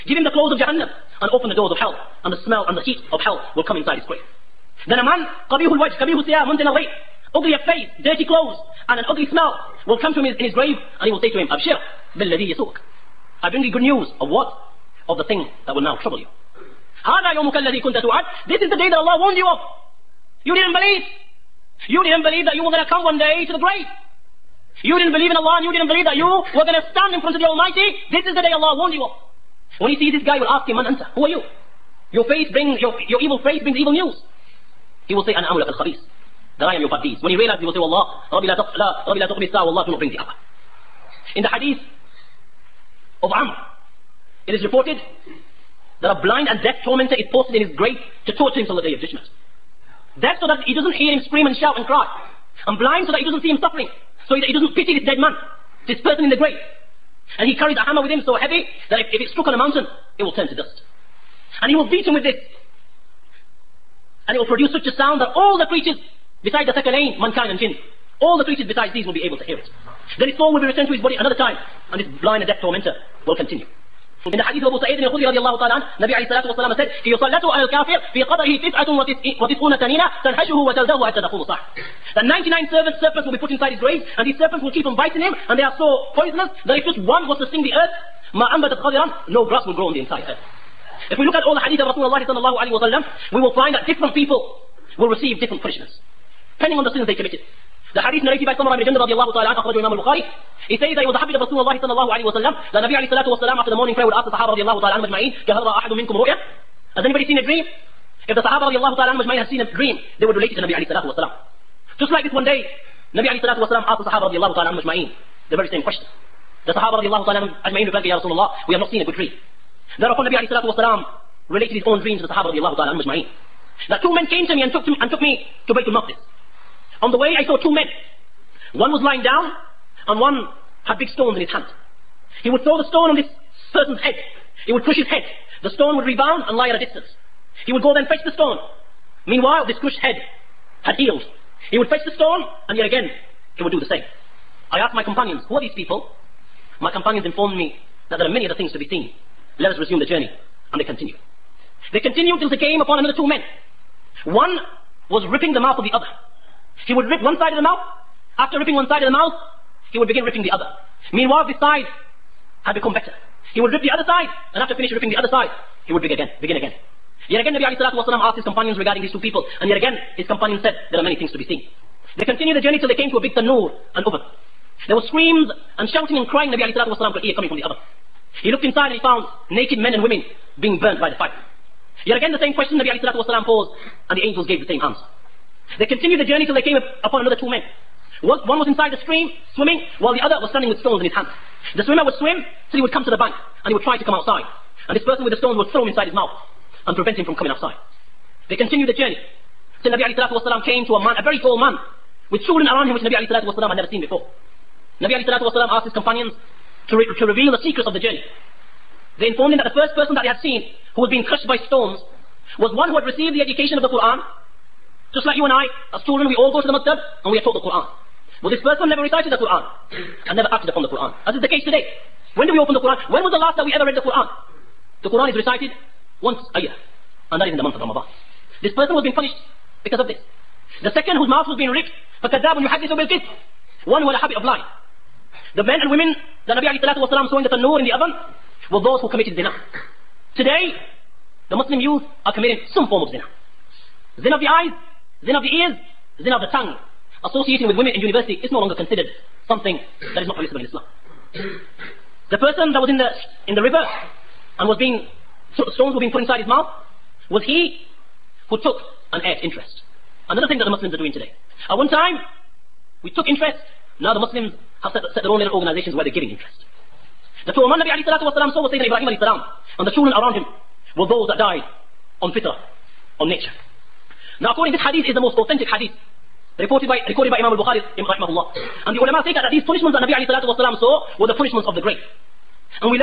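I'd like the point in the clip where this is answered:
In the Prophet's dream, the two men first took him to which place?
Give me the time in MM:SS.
02:05.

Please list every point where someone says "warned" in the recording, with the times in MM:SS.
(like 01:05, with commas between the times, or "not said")
00:19, 00:28.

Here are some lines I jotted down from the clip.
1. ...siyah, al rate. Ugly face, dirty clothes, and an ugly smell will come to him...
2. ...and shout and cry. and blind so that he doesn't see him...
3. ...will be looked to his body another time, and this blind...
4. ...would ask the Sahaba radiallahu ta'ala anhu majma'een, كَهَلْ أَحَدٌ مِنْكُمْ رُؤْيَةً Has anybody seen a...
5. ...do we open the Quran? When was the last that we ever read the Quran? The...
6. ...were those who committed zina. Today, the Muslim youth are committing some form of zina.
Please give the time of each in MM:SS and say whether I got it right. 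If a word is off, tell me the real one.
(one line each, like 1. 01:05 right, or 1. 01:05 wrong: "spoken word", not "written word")
1. 00:06 right
2. 00:51 right
3. 01:10 wrong: "returned", not "looked"
4. 01:44 right
5. 03:42 right
6. 03:58 right.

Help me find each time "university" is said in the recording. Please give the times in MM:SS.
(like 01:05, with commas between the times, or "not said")
04:07.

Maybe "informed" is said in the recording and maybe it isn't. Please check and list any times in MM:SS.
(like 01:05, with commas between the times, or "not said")
02:27, 03:29.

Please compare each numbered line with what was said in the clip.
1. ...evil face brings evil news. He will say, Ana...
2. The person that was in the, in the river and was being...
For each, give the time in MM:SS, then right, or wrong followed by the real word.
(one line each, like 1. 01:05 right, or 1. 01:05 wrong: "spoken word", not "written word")
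1. 00:33 right
2. 04:11 right.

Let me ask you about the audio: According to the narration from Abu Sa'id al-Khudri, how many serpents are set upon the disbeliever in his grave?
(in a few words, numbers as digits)
99.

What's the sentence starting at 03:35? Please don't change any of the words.
Just like you and I, as children, we all go to the maktab and we are taught the Quran.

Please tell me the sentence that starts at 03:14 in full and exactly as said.
And this person with the stones would throw him inside his mouth and prevent him from coming outside.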